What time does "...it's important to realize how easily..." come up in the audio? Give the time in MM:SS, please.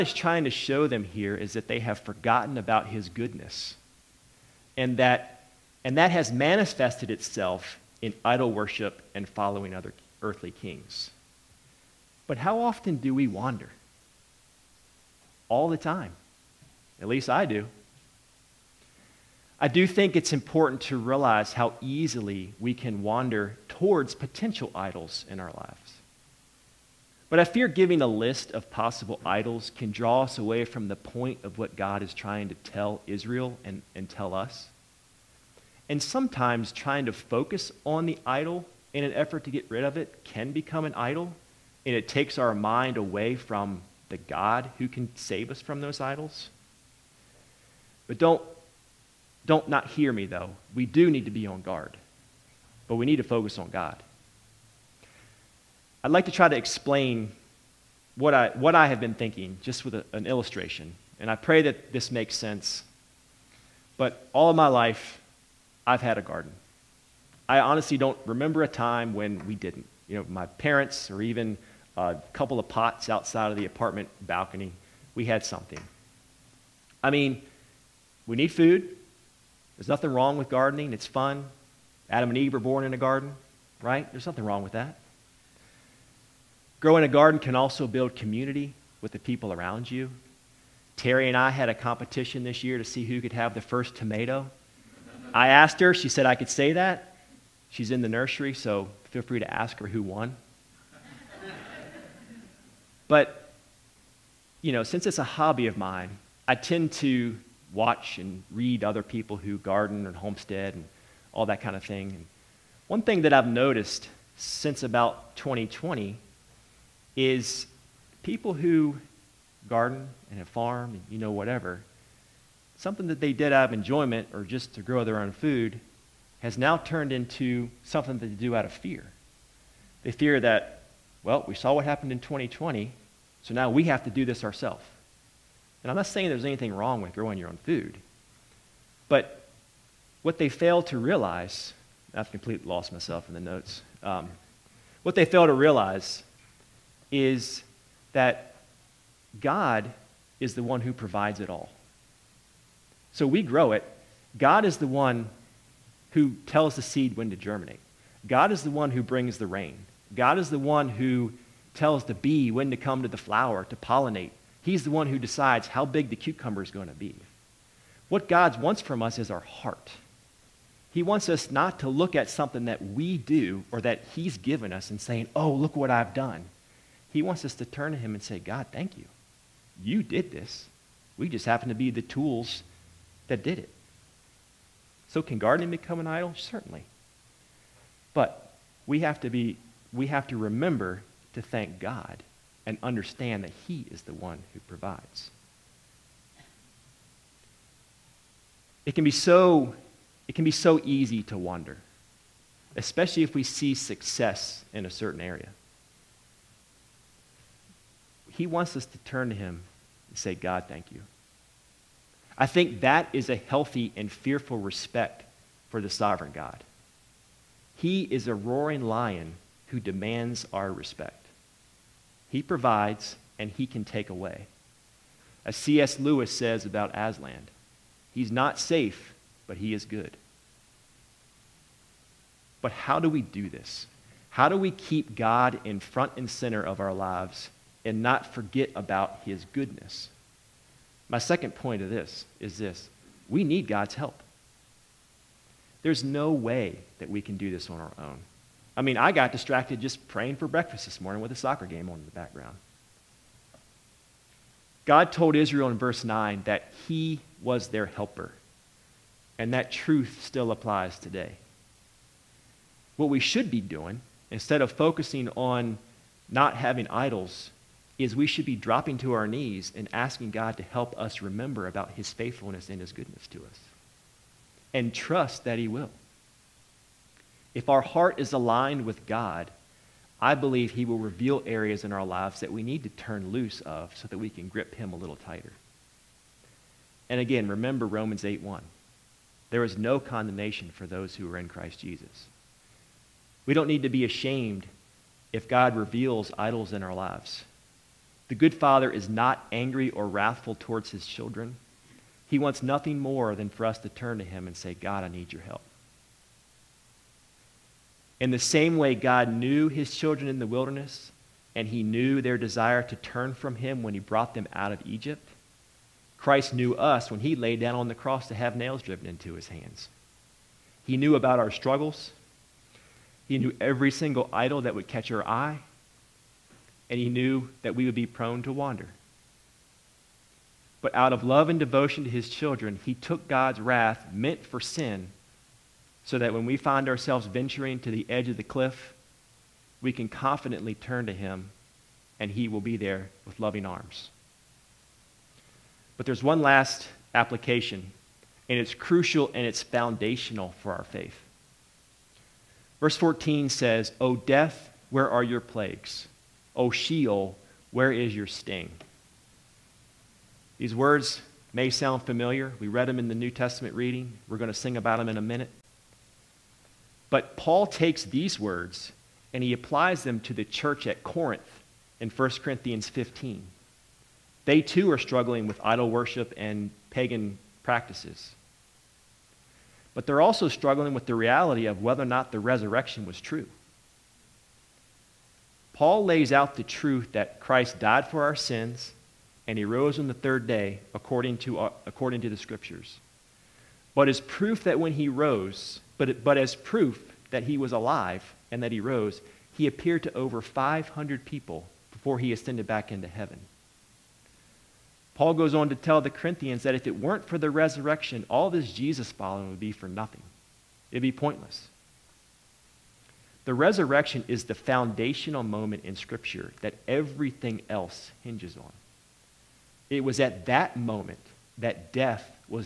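00:20.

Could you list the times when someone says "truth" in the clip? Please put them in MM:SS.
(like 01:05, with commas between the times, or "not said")
04:19, 06:26.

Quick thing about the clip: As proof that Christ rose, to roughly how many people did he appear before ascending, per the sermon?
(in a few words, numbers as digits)
Over 500.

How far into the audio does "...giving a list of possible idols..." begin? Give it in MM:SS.
00:27.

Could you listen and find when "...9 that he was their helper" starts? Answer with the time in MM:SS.
04:16.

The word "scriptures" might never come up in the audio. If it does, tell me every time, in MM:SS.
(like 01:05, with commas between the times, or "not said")
06:32, 06:55.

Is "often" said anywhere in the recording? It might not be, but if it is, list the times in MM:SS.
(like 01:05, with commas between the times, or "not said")
00:12.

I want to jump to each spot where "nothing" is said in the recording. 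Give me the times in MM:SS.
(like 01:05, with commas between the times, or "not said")
01:19, 01:24, 05:02, 06:49.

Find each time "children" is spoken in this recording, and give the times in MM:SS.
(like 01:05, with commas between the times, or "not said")
05:01, 05:09, 05:32.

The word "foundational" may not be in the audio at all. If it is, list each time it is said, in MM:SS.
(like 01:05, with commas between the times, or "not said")
05:49, 06:54.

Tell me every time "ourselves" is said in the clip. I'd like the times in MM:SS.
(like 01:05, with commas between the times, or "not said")
02:14, 05:36.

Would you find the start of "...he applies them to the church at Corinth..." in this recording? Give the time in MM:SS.
06:09.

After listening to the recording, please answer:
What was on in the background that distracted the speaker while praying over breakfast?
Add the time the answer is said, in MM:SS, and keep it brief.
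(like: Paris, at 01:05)
A soccer game, at 04:11.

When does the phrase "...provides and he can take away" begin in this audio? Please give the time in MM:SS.
03:42.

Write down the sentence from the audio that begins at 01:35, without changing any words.
I asked her, she said I could say that.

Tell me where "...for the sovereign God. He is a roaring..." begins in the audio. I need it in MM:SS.
03:35.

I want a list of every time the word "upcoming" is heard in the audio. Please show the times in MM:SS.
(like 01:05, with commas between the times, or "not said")
not said.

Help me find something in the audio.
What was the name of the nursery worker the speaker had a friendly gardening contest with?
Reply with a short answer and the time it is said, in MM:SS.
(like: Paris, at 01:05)
Terry, at 01:30.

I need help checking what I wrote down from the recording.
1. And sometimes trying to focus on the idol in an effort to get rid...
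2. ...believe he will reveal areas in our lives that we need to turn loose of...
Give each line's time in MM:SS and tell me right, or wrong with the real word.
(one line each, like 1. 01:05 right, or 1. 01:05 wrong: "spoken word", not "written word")
1. 00:35 right
2. 04:40 right.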